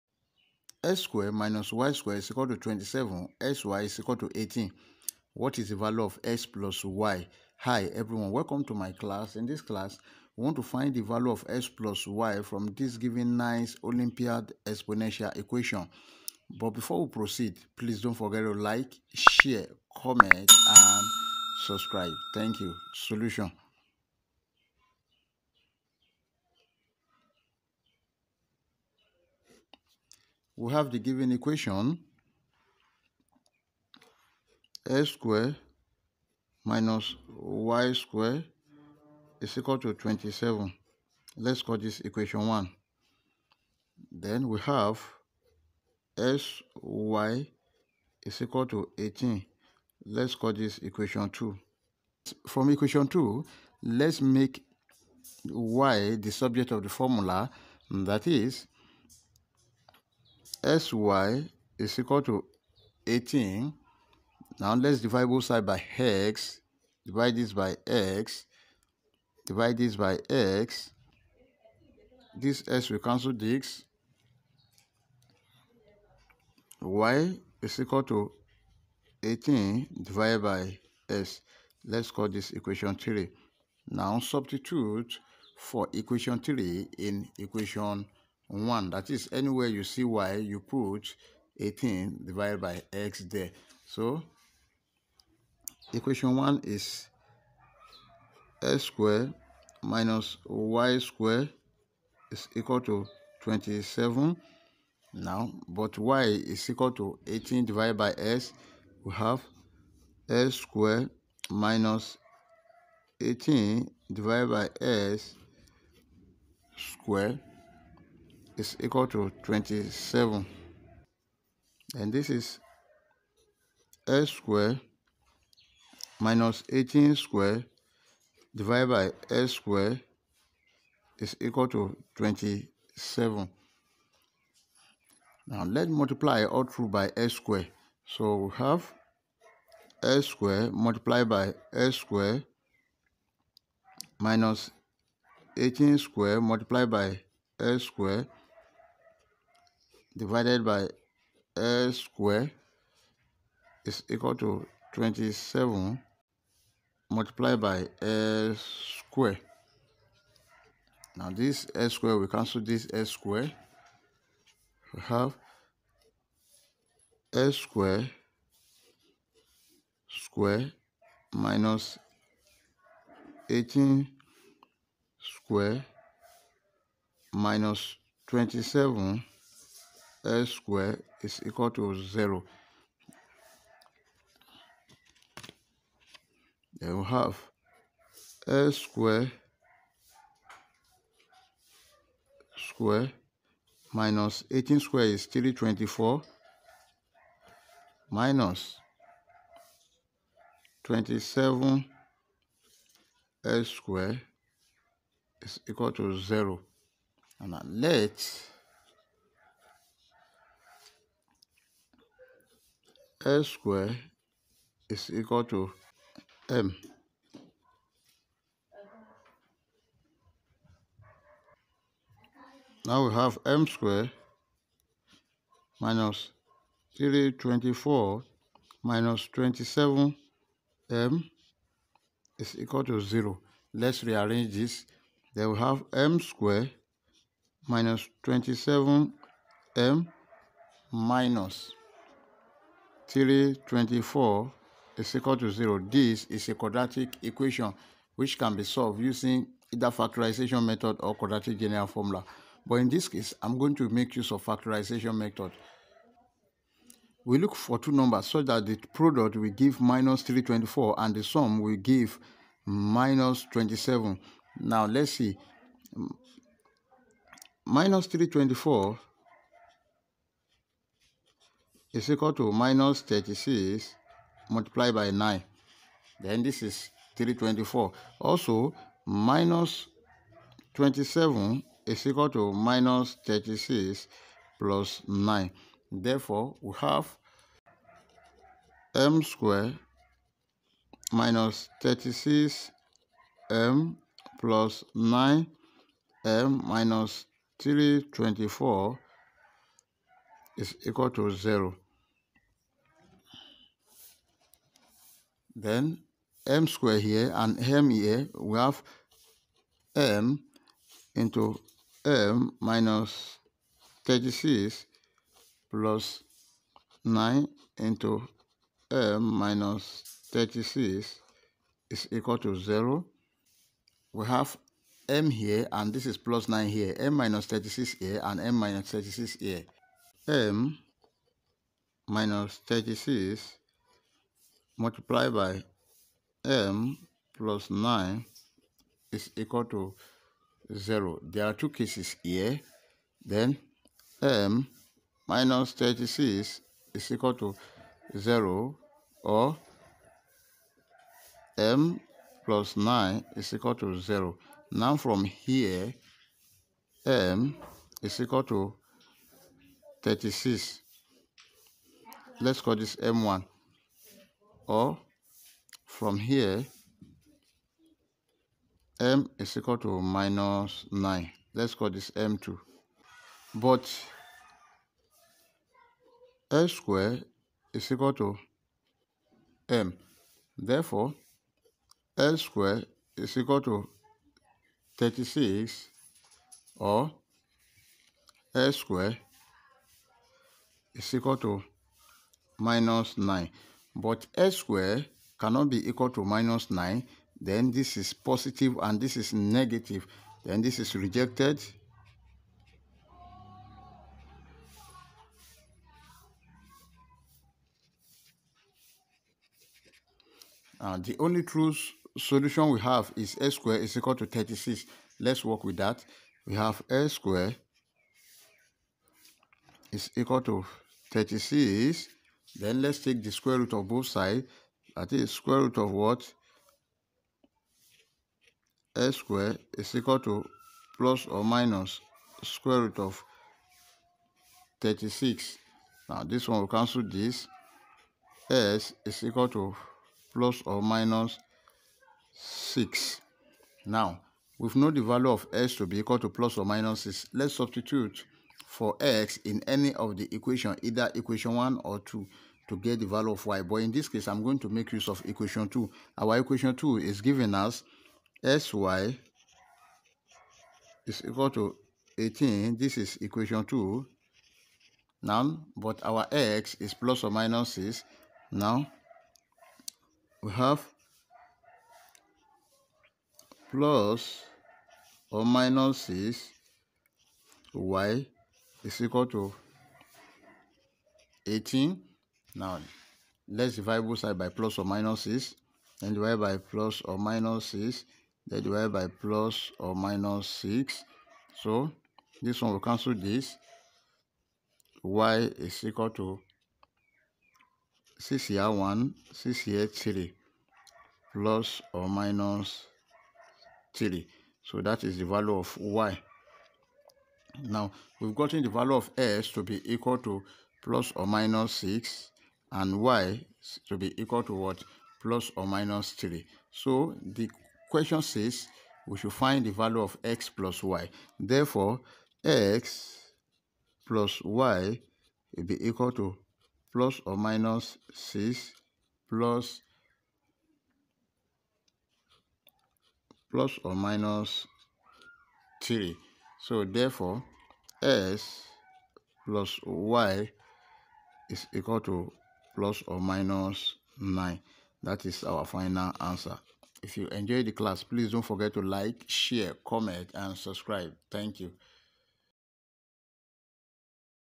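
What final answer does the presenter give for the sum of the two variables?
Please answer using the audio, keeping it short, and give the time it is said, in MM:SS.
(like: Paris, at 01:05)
±9, at 09:02.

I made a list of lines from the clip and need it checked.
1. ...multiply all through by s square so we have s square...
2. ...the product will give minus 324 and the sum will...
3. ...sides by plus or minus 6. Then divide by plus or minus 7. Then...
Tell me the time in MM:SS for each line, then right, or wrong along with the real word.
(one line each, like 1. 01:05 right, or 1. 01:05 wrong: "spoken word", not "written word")
1. 02:16 right
2. 04:18 right
3. 08:04 wrong: "6", not "7".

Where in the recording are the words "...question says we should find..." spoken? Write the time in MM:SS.
08:37.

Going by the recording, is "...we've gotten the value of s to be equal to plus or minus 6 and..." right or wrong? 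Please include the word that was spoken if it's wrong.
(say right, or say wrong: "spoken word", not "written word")
right.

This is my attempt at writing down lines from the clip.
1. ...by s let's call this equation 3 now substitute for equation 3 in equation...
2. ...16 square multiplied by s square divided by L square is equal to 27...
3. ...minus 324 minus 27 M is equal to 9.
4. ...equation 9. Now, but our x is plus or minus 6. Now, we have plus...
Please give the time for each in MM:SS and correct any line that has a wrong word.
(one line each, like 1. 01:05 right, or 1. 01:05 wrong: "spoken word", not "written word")
1. 01:20 right
2. 02:25 wrong: "18", not "16"
3. 03:45 wrong: "0", not "9"
4. 07:43 wrong: "2", not "9".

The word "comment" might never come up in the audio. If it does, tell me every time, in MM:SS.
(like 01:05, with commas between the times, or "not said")
00:19, 09:09.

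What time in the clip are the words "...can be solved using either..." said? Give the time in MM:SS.
04:08.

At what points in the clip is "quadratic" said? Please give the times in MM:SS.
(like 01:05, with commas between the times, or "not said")
04:06, 04:11.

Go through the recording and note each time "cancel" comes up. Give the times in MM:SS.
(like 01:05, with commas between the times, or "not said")
01:12, 02:42, 07:16, 08:12.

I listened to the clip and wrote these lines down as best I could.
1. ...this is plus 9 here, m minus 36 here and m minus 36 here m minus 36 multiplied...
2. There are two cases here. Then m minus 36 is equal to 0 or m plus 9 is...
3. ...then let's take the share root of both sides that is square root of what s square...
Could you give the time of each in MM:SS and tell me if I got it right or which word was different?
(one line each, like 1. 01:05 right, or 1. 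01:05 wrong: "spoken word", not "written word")
1. 05:25 right
2. 05:41 right
3. 07:02 wrong: "square", not "share".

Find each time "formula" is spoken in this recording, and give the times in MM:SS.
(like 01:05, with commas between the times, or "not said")
00:56, 04:11.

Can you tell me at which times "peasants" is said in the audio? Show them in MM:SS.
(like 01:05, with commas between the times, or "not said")
not said.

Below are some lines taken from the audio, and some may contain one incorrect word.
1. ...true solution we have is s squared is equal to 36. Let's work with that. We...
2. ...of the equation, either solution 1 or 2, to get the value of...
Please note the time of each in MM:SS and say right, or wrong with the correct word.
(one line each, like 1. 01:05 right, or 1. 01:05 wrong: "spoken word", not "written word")
1. 06:51 right
2. 07:29 wrong: "equation", not "solution".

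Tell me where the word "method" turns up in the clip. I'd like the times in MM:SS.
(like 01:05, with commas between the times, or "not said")
04:10, 04:15.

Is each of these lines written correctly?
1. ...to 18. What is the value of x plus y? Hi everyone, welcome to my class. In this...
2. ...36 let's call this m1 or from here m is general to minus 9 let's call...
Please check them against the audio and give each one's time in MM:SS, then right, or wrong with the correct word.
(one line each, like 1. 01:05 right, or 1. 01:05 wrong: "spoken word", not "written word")
1. 00:04 right
2. 06:00 wrong: "equal", not "general".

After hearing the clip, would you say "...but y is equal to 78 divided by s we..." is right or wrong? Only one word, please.
wrong.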